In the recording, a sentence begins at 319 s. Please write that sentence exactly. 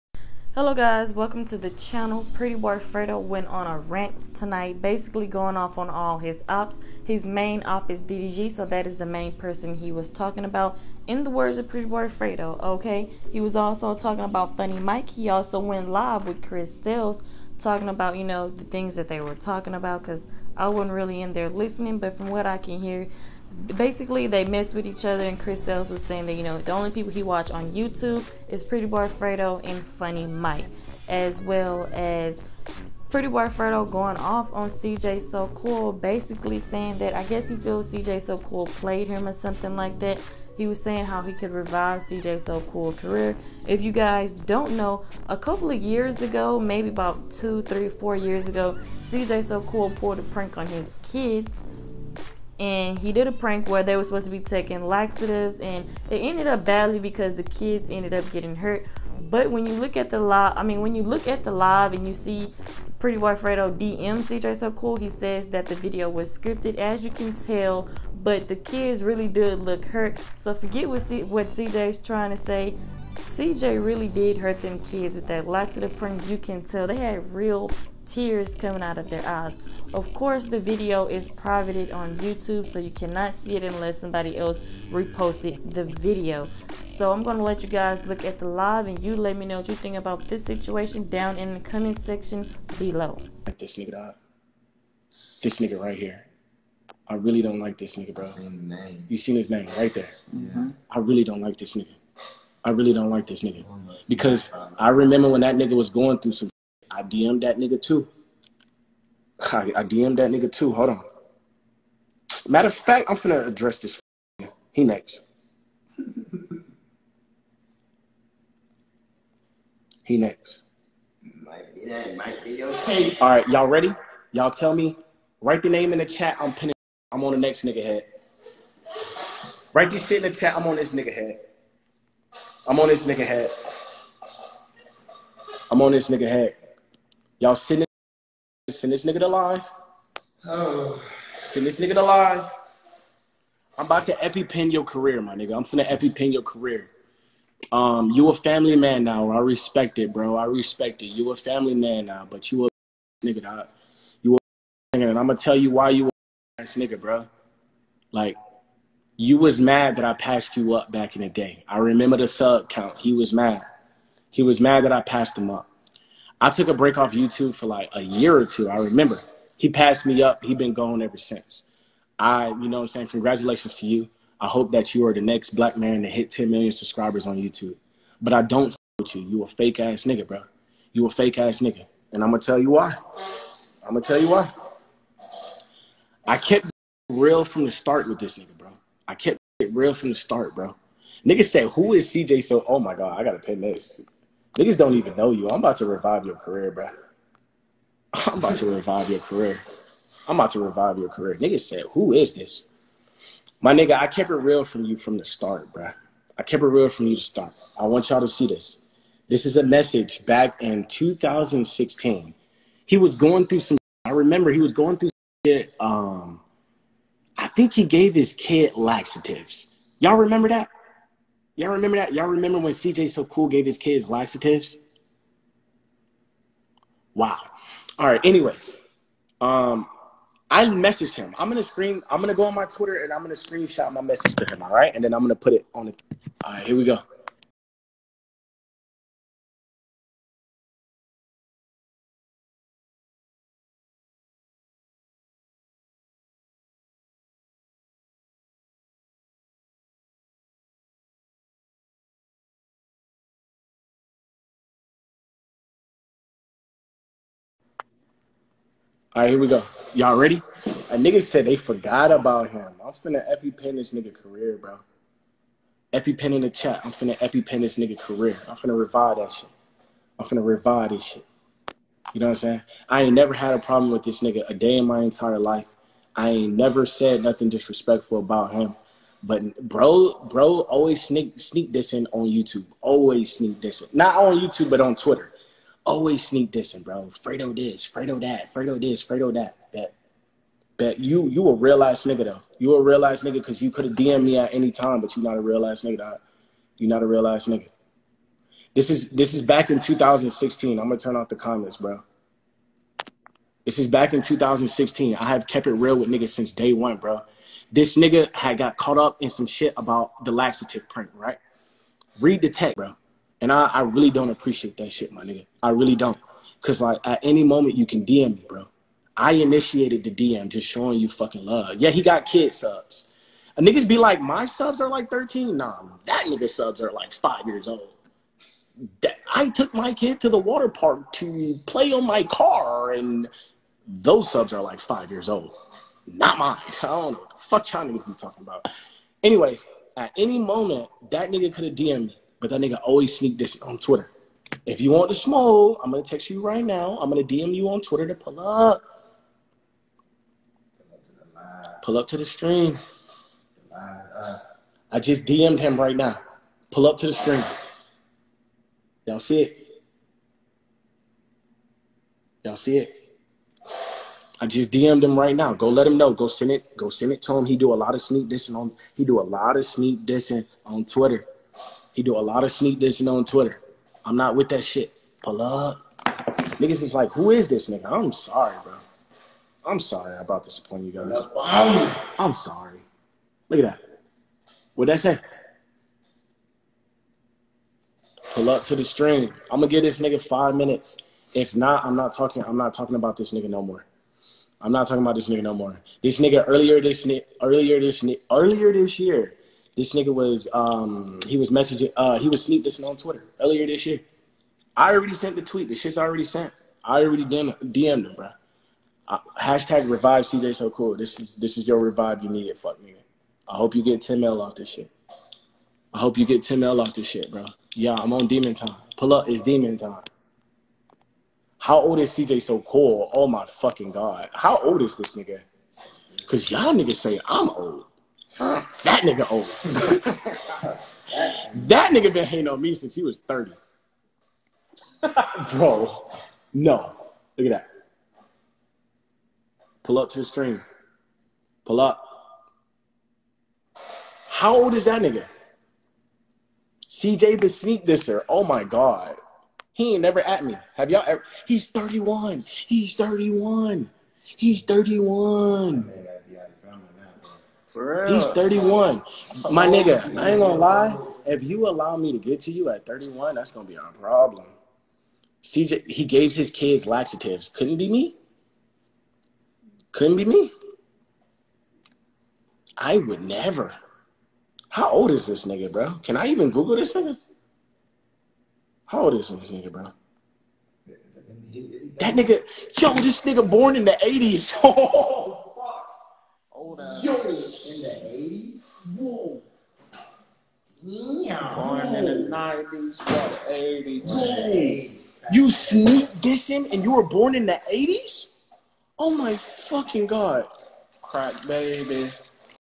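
I initiated the DM just showing you fucking love.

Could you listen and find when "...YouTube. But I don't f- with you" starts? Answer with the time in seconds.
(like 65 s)
177 s.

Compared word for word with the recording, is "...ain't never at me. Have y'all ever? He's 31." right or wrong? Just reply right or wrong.
right.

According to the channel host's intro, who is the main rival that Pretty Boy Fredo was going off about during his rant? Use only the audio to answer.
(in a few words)
DDG.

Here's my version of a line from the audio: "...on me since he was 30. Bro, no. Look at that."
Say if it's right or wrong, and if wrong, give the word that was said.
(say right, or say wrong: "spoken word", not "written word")
right.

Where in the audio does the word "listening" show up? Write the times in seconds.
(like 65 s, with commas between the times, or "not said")
21 s, 402 s.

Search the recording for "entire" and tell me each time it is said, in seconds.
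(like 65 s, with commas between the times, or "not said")
275 s.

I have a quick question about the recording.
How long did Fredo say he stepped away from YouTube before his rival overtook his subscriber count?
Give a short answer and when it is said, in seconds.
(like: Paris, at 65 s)
a year or two, at 167 s.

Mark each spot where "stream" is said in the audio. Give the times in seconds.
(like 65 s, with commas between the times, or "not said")
352 s, 357 s, 388 s, 440 s.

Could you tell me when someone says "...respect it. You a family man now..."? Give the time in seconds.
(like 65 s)
150 s.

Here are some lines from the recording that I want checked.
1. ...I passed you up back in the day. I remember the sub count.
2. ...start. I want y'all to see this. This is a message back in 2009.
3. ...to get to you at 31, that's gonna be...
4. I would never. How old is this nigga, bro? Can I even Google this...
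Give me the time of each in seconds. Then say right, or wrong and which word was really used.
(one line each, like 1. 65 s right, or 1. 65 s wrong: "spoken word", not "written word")
1. 160 s right
2. 207 s wrong: "2016", not "2009"
3. 462 s right
4. 472 s right.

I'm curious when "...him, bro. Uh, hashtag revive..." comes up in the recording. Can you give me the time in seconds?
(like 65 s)
408 s.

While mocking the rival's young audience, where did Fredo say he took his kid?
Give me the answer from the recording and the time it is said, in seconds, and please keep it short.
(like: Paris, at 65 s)
the water park, at 330 s.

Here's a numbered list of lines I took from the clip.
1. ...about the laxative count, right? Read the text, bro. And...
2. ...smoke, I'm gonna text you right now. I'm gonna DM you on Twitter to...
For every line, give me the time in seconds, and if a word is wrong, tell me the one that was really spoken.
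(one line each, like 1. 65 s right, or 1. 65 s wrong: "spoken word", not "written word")
1. 309 s wrong: "print", not "count"
2. 345 s right.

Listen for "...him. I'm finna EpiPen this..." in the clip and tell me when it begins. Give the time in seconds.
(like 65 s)
262 s.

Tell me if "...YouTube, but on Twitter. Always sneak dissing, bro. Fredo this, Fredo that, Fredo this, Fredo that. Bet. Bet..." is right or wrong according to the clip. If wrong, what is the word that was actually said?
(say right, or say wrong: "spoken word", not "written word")
right.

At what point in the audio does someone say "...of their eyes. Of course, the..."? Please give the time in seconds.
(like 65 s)
78 s.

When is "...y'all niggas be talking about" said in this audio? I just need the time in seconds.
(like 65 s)
337 s.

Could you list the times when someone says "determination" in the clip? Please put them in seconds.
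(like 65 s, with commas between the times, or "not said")
not said.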